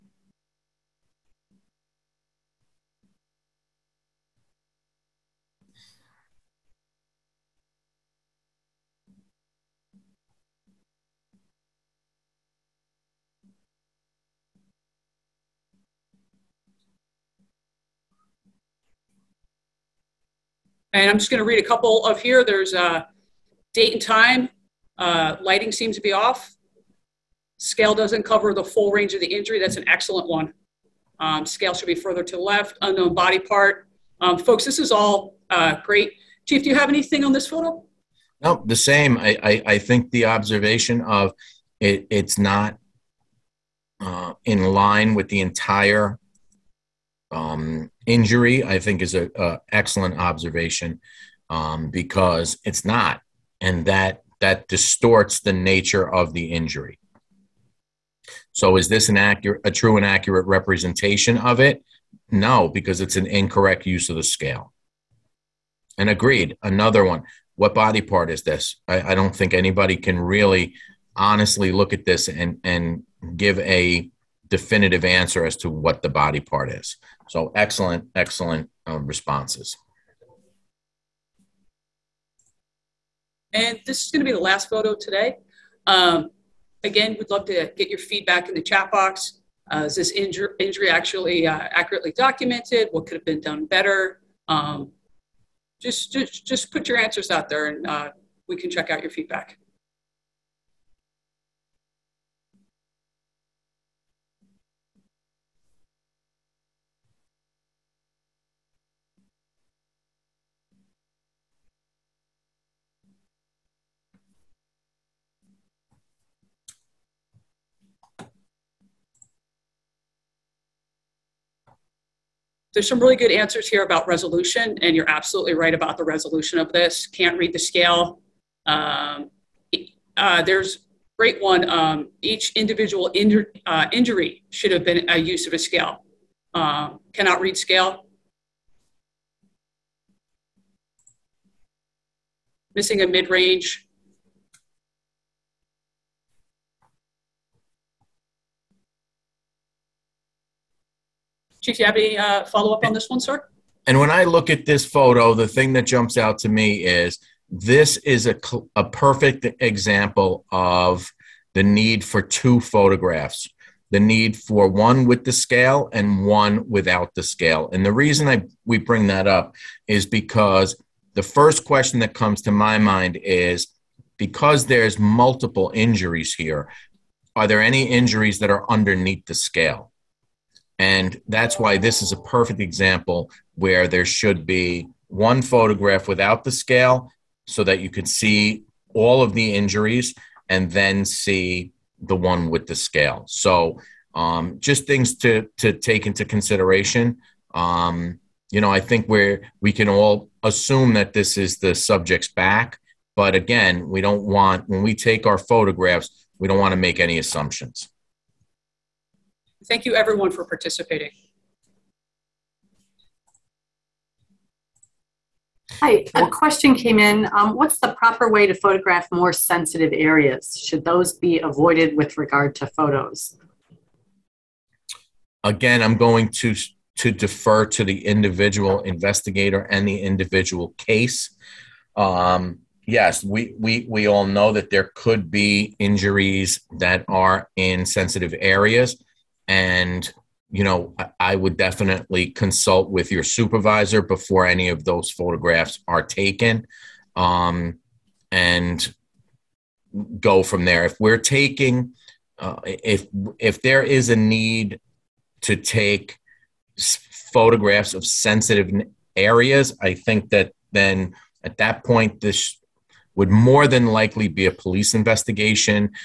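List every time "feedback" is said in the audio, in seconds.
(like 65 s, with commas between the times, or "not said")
87 s, 99 s.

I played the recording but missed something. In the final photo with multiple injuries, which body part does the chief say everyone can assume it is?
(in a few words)
the subject's back.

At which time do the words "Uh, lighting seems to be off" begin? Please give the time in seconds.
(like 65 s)
24 s.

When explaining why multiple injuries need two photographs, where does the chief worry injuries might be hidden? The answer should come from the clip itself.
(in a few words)
underneath the scale.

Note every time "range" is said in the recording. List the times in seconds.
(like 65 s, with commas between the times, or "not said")
28 s, 143 s.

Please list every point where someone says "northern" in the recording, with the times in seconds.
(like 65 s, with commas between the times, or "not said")
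not said.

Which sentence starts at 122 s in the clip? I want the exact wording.
there's some really good answers here about resolution, and you're absolutely right about the resolution of this.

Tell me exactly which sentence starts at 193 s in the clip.
So, um, just things to, to take into consideration.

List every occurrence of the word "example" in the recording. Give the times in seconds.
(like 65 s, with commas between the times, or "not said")
159 s, 182 s.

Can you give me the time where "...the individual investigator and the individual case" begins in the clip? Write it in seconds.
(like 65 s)
227 s.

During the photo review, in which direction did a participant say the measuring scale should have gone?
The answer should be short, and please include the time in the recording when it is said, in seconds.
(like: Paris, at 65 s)
further to the left, at 31 s.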